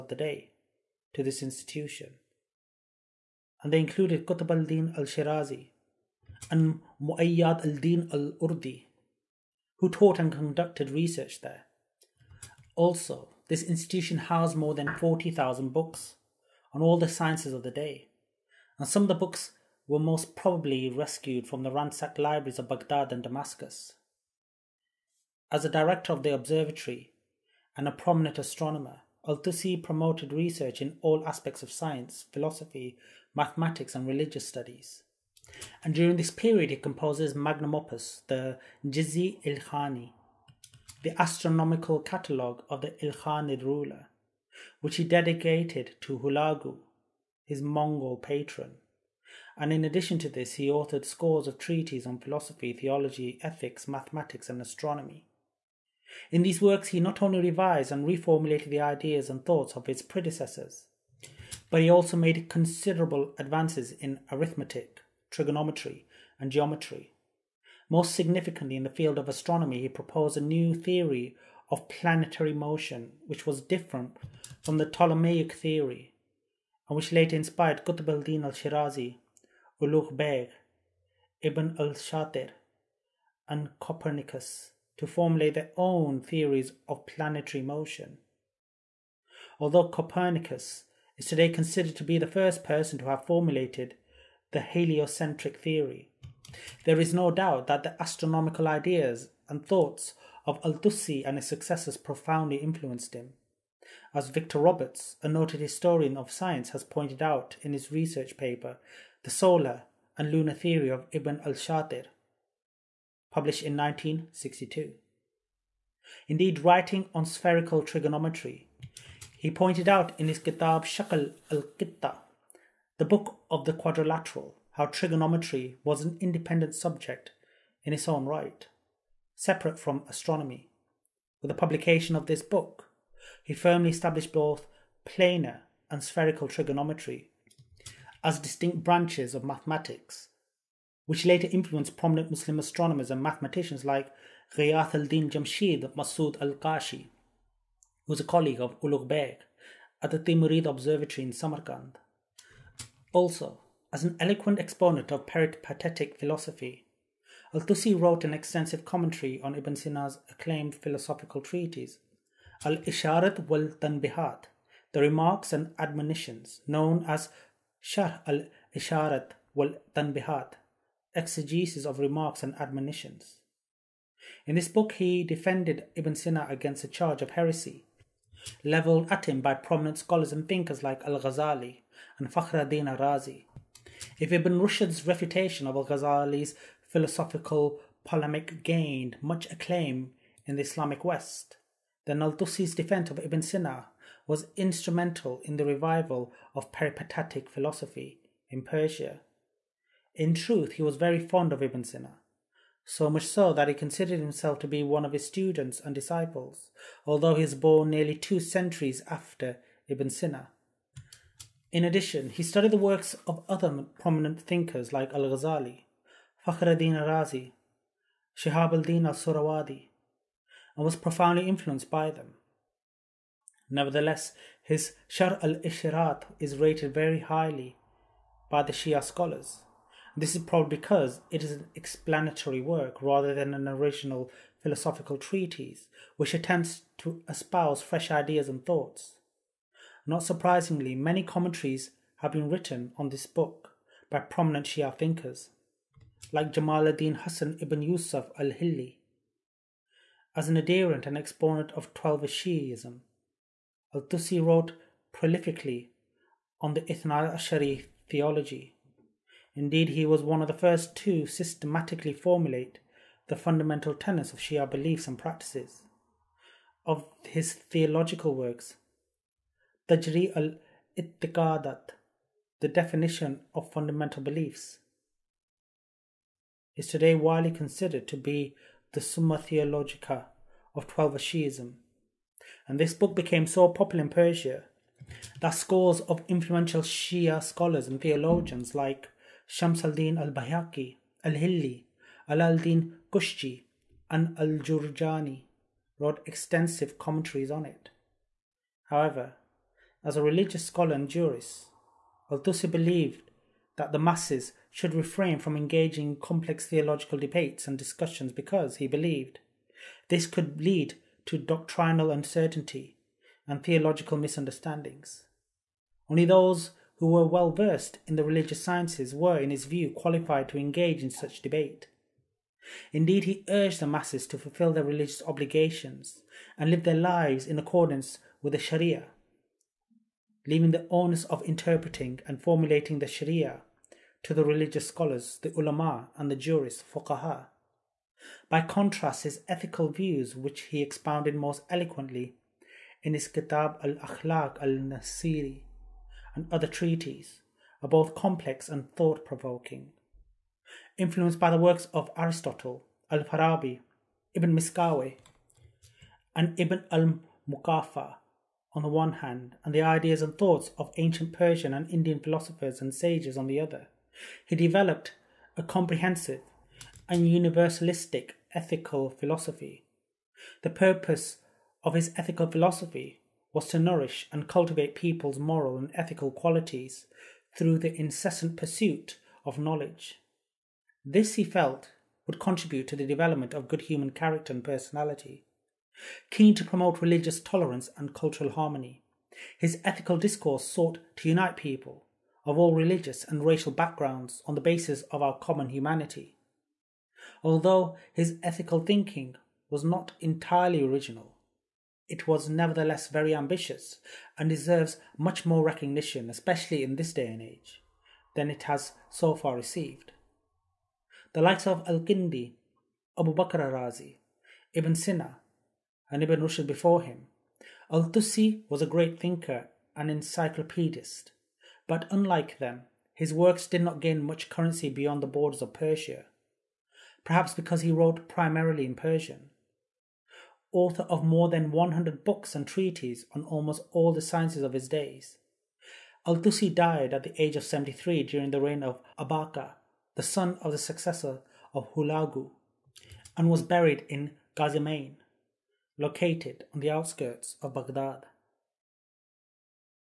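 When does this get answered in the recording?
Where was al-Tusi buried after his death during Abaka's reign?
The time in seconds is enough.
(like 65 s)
444 s.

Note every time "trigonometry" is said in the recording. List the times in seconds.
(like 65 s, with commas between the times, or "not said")
65 s, 117 s, 124 s, 136 s.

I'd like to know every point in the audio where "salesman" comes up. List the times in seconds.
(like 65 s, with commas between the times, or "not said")
not said.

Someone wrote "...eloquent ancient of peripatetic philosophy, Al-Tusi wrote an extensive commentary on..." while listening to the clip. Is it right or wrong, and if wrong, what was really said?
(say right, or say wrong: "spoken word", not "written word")
wrong: "exponent", not "ancient".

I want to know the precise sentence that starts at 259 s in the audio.
Indeed, he was one of the first to systematically formulate the fundamental tenets of Shia beliefs and practices.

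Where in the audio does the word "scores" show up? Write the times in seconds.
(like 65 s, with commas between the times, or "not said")
51 s, 285 s.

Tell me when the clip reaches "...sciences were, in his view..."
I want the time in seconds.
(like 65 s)
318 s.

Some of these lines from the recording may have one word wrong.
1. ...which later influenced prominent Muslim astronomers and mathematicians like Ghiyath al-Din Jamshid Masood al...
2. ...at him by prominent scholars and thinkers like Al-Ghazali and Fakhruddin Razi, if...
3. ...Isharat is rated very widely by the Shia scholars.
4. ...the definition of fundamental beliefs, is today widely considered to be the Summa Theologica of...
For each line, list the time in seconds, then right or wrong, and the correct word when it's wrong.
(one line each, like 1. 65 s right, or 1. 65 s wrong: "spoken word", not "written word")
1. 141 s right
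2. 179 s right
3. 225 s wrong: "highly", not "widely"
4. 272 s right.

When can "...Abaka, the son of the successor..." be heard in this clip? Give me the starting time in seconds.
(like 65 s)
439 s.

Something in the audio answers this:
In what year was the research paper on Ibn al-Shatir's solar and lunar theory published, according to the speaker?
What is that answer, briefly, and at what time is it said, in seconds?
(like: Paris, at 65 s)
1962, at 113 s.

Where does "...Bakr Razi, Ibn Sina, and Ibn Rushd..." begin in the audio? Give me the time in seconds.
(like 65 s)
413 s.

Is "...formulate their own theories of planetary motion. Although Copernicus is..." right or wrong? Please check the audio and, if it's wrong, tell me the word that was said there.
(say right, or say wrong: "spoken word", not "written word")
right.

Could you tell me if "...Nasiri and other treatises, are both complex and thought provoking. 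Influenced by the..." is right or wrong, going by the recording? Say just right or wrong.
right.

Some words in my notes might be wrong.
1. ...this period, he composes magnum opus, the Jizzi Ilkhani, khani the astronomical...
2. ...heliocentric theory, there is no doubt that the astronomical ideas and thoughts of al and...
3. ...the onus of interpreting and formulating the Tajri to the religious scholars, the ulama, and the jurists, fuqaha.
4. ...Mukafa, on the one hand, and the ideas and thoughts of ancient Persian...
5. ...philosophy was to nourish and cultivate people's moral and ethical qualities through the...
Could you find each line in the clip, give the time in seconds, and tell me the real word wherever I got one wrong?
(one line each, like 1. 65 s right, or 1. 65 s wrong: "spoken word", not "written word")
1. 36 s right
2. 94 s right
3. 330 s wrong: "Sharia", not "Tajri"
4. 357 s right
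5. 372 s right.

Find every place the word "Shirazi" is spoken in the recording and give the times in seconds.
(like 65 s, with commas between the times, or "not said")
4 s, 78 s.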